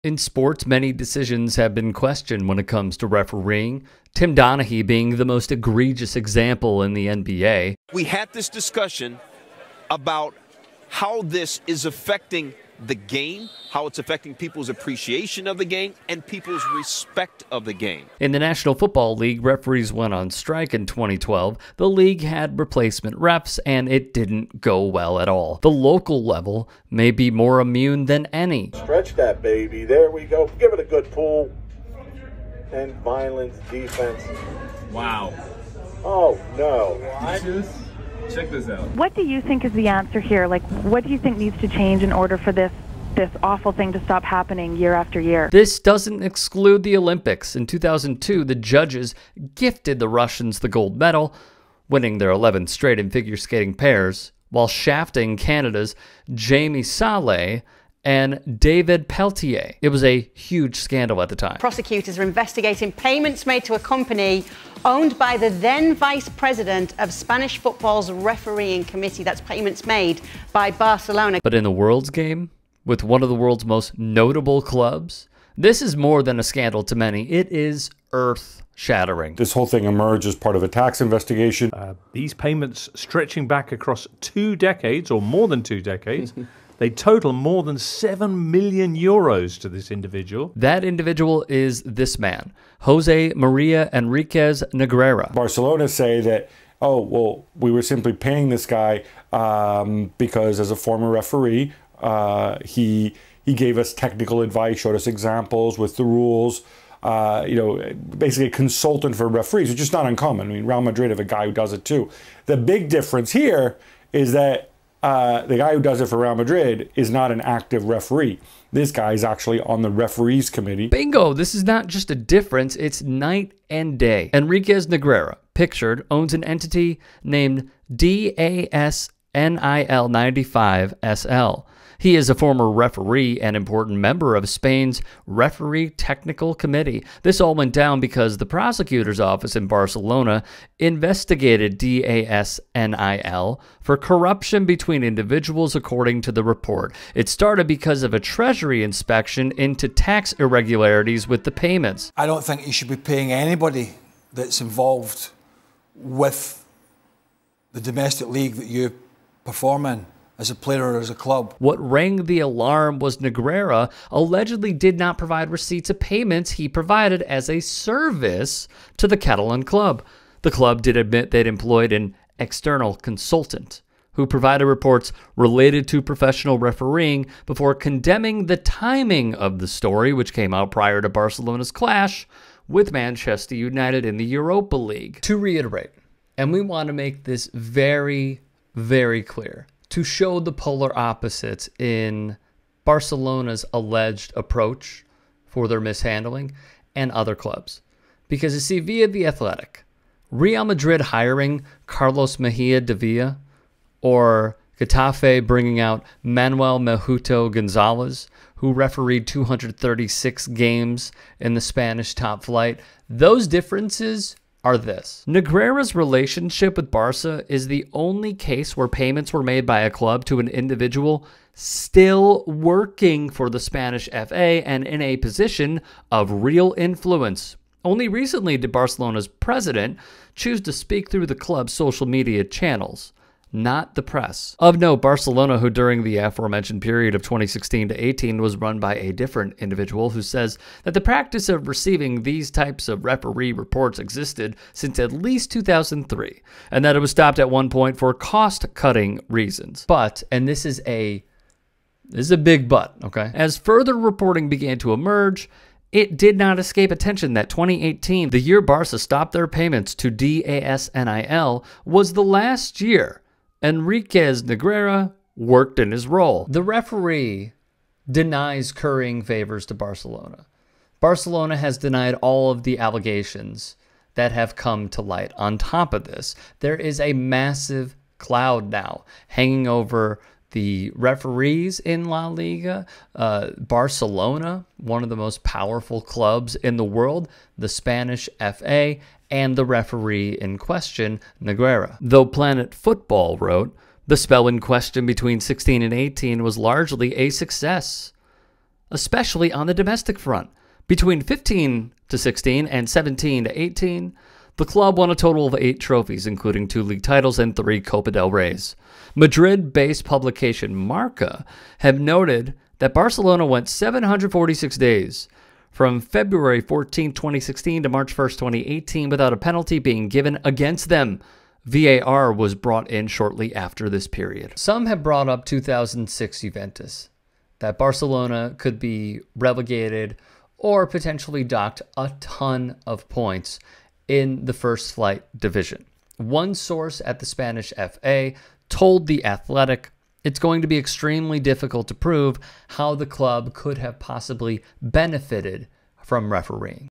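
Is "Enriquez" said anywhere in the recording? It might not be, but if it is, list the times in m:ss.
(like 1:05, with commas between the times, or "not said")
1:33, 2:04, 4:23.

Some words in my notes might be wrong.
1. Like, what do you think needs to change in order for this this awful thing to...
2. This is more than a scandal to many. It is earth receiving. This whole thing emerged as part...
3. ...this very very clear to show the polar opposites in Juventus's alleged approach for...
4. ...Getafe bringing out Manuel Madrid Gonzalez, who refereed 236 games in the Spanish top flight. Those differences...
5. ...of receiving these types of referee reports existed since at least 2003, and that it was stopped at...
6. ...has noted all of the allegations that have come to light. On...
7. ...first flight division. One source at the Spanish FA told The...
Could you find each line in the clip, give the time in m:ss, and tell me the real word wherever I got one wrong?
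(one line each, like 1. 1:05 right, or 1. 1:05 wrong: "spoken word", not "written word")
1. 0:40 right
2. 1:15 wrong: "shattering", not "receiving"
3. 3:07 wrong: "Barcelona", not "Juventus"
4. 3:24 wrong: "Mejuto", not "Madrid"
5. 4:01 right
6. 4:31 wrong: "denied", not "noted"
7. 5:34 right.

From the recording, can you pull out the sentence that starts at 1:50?
I mean, Real Madrid have a guy who does it too.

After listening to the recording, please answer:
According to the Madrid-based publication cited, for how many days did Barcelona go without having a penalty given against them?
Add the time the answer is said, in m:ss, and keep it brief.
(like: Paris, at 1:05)
746, at 5:13.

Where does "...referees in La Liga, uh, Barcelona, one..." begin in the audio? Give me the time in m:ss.
4:40.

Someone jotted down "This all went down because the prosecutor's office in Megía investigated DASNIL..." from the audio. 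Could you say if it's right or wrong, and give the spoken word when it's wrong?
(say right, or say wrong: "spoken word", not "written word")
wrong: "Barcelona", not "Megía".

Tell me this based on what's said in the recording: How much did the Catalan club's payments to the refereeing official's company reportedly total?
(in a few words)
more than 7 million euros.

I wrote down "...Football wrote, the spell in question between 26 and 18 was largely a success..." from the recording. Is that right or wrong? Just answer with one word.
wrong.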